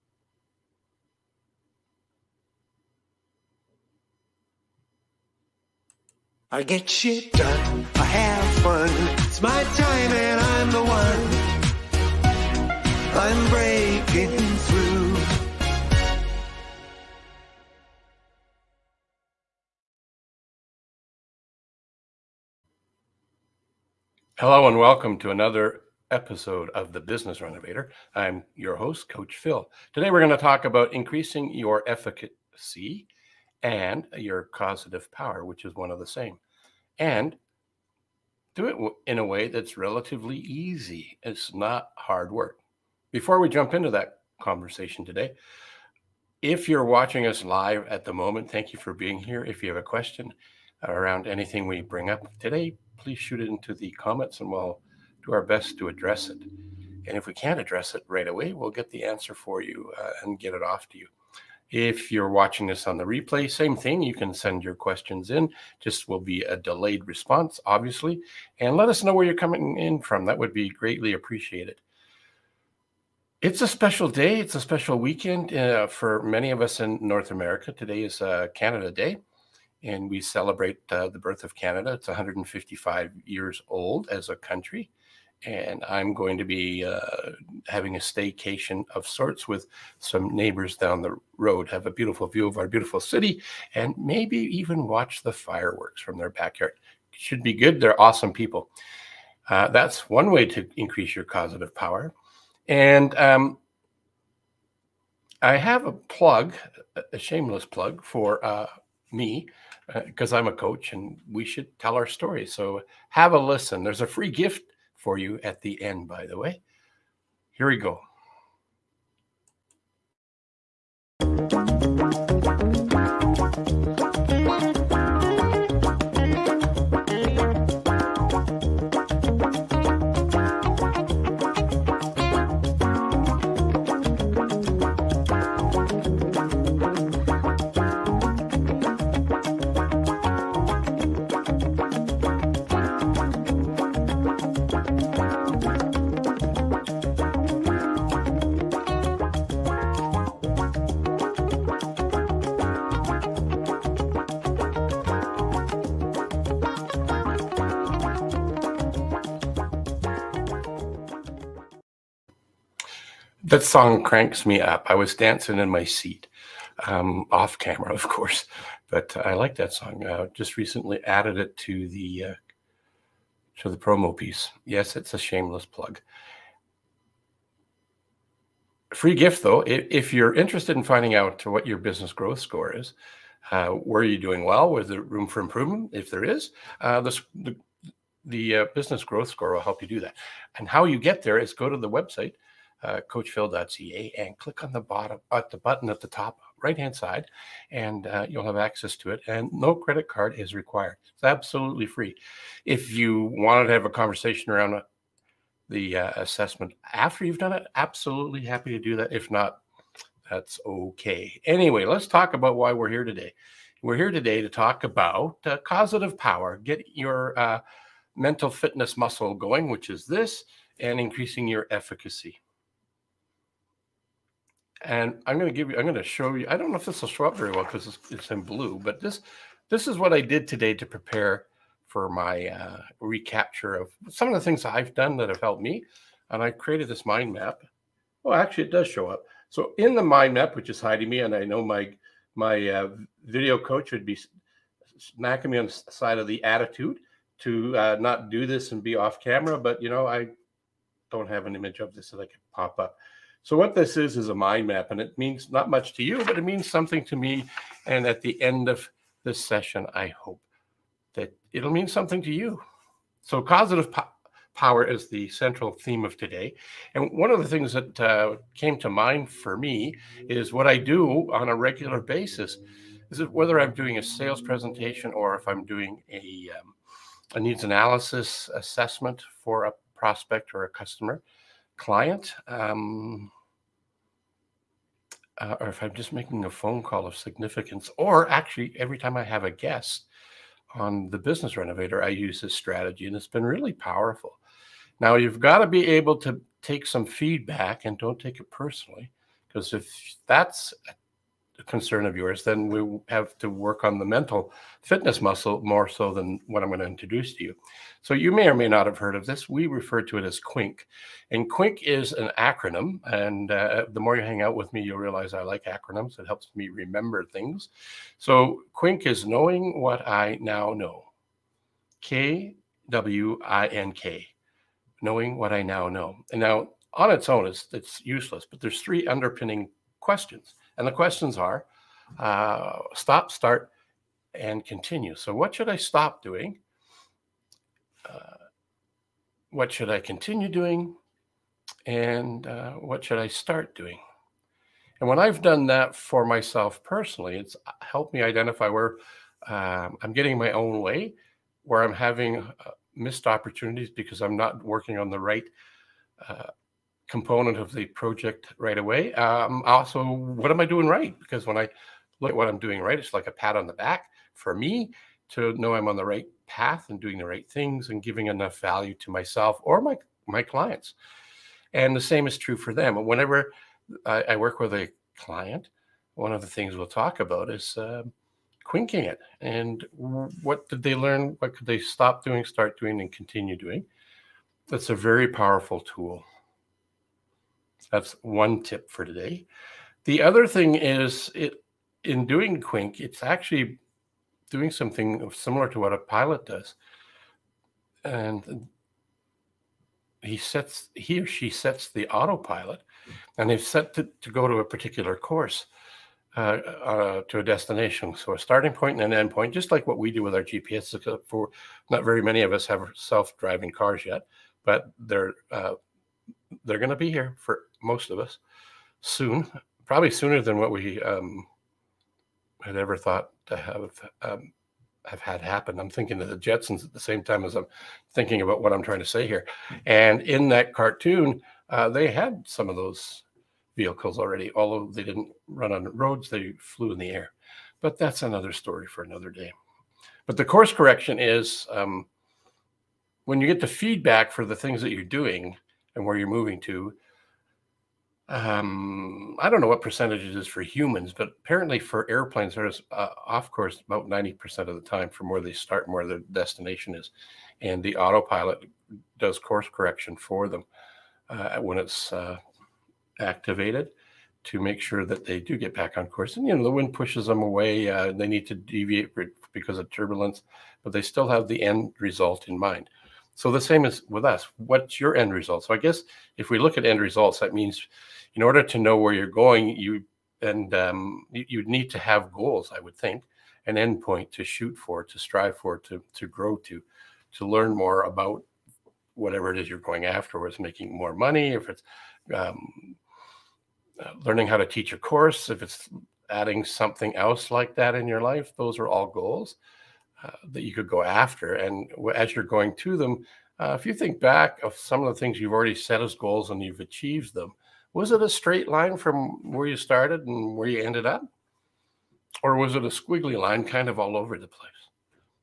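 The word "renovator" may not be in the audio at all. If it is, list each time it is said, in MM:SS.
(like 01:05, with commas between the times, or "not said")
00:27, 04:51.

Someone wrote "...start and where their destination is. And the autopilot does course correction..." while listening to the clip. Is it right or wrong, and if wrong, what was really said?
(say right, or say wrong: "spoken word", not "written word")
right.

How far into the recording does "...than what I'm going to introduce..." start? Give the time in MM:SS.
05:06.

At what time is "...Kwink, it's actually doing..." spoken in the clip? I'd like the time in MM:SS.
06:32.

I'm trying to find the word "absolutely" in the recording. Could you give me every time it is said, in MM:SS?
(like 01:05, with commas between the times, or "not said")
03:21, 03:27.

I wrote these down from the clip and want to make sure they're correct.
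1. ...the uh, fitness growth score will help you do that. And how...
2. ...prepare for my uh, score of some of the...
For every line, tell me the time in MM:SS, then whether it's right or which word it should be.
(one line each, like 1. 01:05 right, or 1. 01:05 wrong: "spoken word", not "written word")
1. 03:08 wrong: "business", not "fitness"
2. 03:50 wrong: "recapture", not "score".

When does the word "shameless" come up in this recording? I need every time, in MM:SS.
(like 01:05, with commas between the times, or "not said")
01:47, 02:55.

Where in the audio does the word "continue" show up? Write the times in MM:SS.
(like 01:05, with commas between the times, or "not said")
05:34, 05:39, 06:23.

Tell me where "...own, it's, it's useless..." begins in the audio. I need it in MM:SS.
05:27.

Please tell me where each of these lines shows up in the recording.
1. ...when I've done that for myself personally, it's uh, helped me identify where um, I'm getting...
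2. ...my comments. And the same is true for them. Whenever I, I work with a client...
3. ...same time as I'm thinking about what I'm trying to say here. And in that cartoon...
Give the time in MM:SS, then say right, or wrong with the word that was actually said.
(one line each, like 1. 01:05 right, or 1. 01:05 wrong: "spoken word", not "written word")
1. 05:45 right
2. 06:10 wrong: "clients", not "comments"
3. 07:06 right.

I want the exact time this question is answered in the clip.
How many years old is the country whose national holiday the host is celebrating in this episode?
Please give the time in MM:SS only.
01:22.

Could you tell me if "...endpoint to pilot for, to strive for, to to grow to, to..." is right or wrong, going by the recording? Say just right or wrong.
wrong.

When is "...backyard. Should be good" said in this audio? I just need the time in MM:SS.
01:36.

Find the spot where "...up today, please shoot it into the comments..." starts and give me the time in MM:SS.
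00:52.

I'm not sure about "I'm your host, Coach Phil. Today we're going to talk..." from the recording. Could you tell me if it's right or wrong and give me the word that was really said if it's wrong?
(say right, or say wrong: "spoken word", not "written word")
right.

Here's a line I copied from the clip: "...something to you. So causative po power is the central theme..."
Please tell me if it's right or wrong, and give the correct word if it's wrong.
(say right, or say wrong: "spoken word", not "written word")
right.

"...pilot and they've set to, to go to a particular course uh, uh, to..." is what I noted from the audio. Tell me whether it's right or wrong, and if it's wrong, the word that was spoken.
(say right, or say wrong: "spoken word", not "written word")
wrong: "autopilot", not "pilot".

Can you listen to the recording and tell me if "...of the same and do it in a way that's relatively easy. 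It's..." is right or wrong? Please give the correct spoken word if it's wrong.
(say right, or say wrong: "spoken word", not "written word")
right.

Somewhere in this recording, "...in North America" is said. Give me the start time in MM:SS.
01:16.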